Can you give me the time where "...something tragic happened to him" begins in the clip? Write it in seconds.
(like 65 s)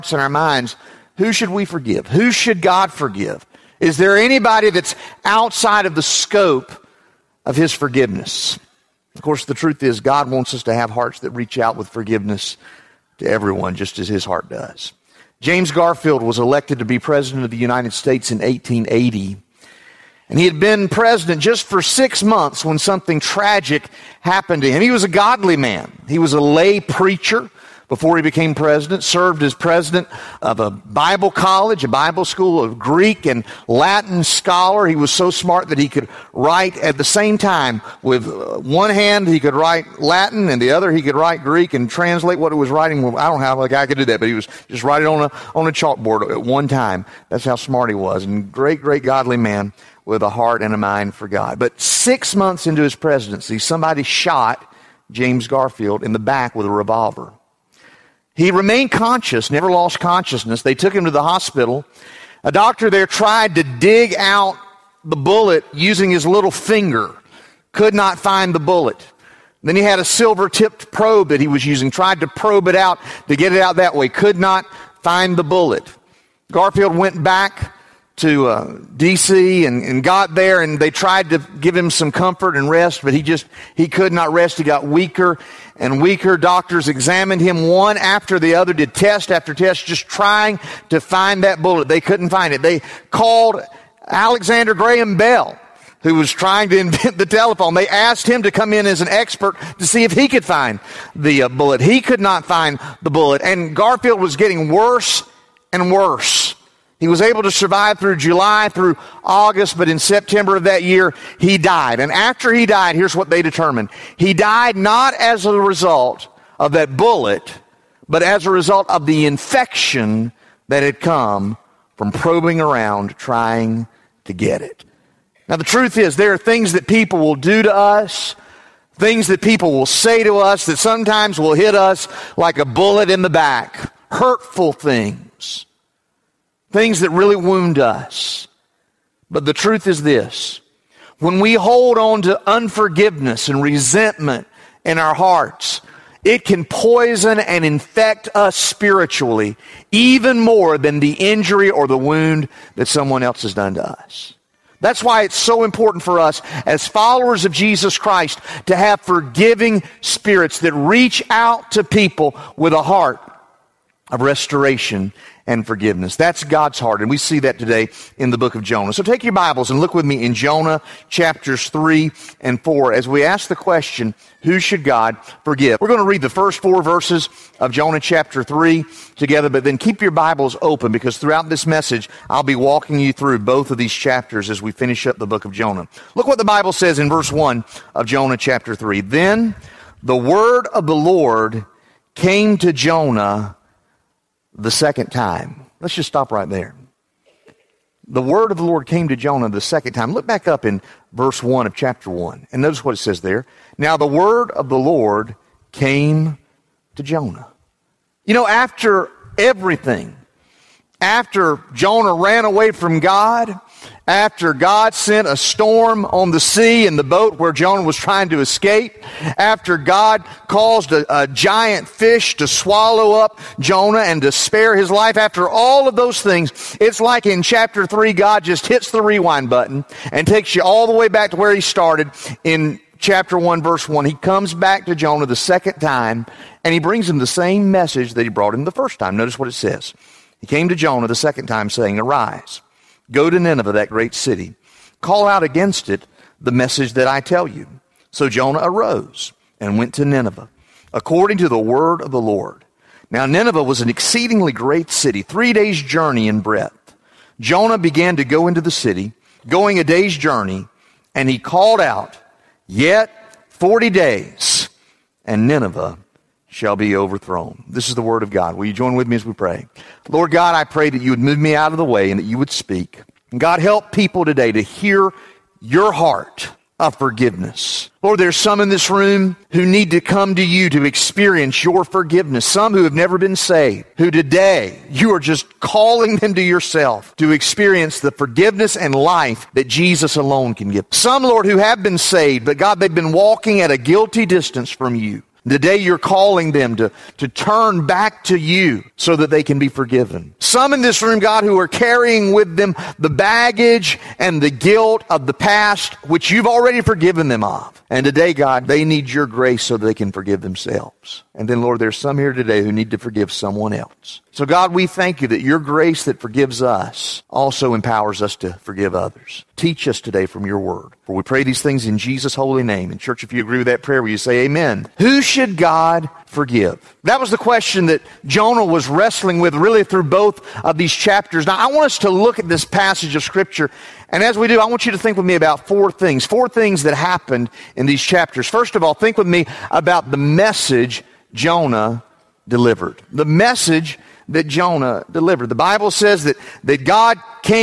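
22 s.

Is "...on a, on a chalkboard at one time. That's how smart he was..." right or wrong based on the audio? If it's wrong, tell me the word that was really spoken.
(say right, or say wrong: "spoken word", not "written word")
right.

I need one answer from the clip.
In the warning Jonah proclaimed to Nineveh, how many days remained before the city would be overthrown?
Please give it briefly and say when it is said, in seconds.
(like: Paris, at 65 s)
40, at 263 s.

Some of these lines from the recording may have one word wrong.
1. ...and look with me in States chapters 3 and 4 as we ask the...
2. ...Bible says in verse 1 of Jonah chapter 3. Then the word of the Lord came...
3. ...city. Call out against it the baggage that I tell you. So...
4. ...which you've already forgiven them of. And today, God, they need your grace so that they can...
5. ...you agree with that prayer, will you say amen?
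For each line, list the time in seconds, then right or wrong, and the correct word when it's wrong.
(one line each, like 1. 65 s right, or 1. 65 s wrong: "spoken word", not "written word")
1. 169 s wrong: "Jonah", not "States"
2. 186 s right
3. 244 s wrong: "message", not "baggage"
4. 306 s right
5. 323 s right.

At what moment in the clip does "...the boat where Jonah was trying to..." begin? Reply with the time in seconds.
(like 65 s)
216 s.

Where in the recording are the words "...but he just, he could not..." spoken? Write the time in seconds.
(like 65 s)
83 s.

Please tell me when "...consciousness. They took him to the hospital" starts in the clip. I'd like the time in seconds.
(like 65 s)
59 s.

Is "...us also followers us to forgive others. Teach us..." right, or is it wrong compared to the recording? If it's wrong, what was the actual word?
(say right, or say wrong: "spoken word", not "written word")
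wrong: "empowers", not "followers".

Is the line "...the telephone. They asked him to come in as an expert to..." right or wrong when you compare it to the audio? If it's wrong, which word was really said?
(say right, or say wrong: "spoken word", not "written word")
right.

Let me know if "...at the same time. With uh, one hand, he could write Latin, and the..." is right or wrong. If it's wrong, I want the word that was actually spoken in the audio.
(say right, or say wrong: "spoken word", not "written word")
right.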